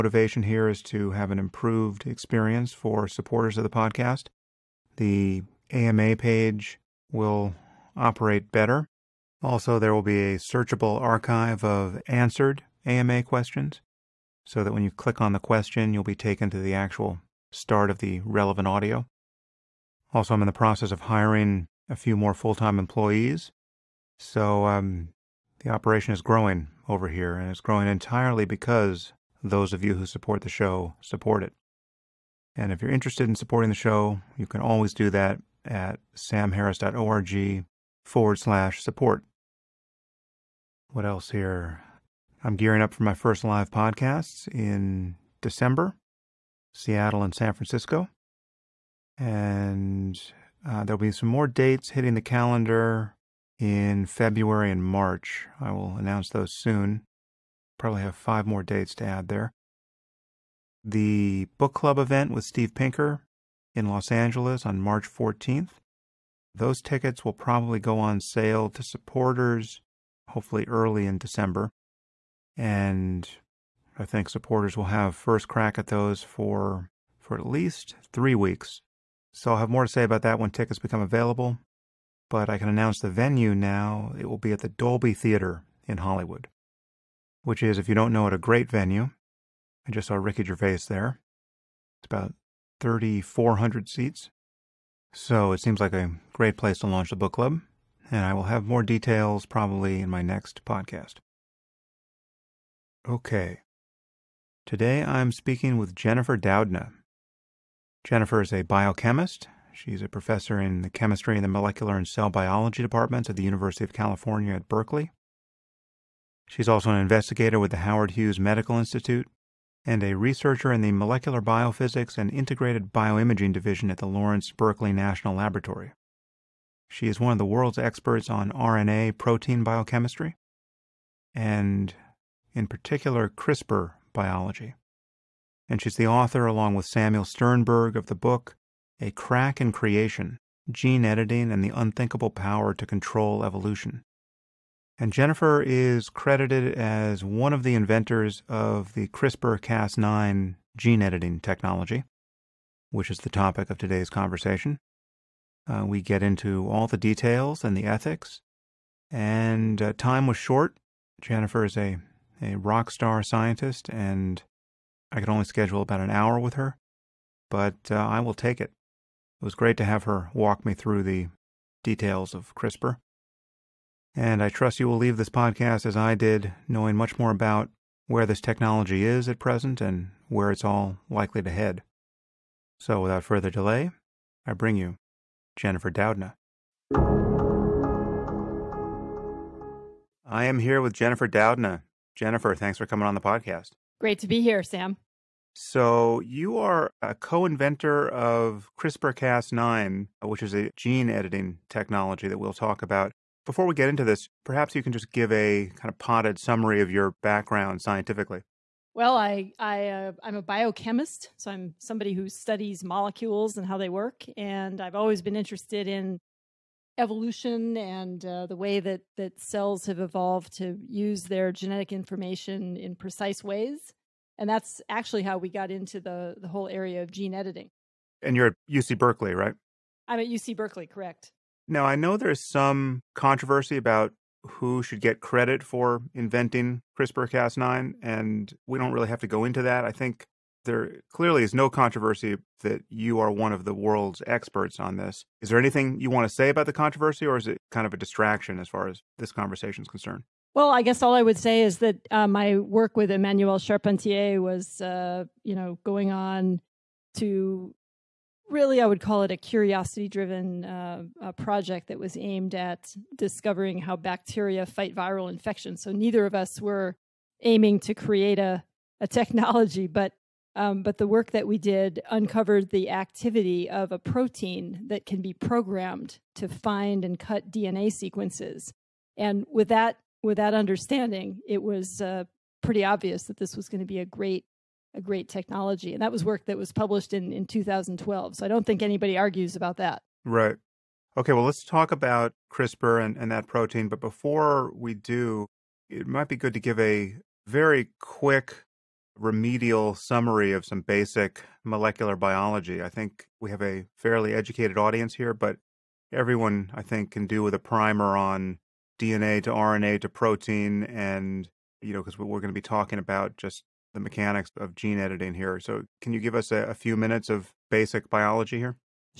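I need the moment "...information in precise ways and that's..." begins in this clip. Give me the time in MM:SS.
03:41.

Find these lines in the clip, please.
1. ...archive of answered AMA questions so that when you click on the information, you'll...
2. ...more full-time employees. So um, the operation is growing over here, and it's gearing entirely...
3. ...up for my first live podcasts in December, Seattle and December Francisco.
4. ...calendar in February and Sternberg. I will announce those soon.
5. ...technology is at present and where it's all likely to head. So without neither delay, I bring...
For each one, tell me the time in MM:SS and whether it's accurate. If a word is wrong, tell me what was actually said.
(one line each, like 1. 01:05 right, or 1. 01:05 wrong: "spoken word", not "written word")
1. 00:11 wrong: "question", not "information"
2. 00:22 wrong: "growing", not "gearing"
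3. 00:42 wrong: "San", not "December"
4. 00:52 wrong: "March", not "Sternberg"
5. 02:58 wrong: "further", not "neither".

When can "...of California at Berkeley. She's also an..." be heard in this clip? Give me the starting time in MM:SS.
01:53.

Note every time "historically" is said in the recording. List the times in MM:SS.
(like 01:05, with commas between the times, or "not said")
not said.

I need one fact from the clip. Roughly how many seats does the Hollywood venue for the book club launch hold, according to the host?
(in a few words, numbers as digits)
3,400.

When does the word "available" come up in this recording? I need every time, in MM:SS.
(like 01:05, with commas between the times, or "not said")
01:21.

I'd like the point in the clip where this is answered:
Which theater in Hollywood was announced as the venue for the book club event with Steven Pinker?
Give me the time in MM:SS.
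01:24.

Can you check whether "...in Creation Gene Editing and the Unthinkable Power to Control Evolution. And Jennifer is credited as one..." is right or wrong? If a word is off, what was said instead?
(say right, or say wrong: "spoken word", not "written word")
right.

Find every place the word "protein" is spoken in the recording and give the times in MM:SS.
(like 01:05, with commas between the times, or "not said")
02:09, 04:33, 04:53, 05:10.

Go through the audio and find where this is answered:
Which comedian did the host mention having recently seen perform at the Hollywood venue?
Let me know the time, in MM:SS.
01:30.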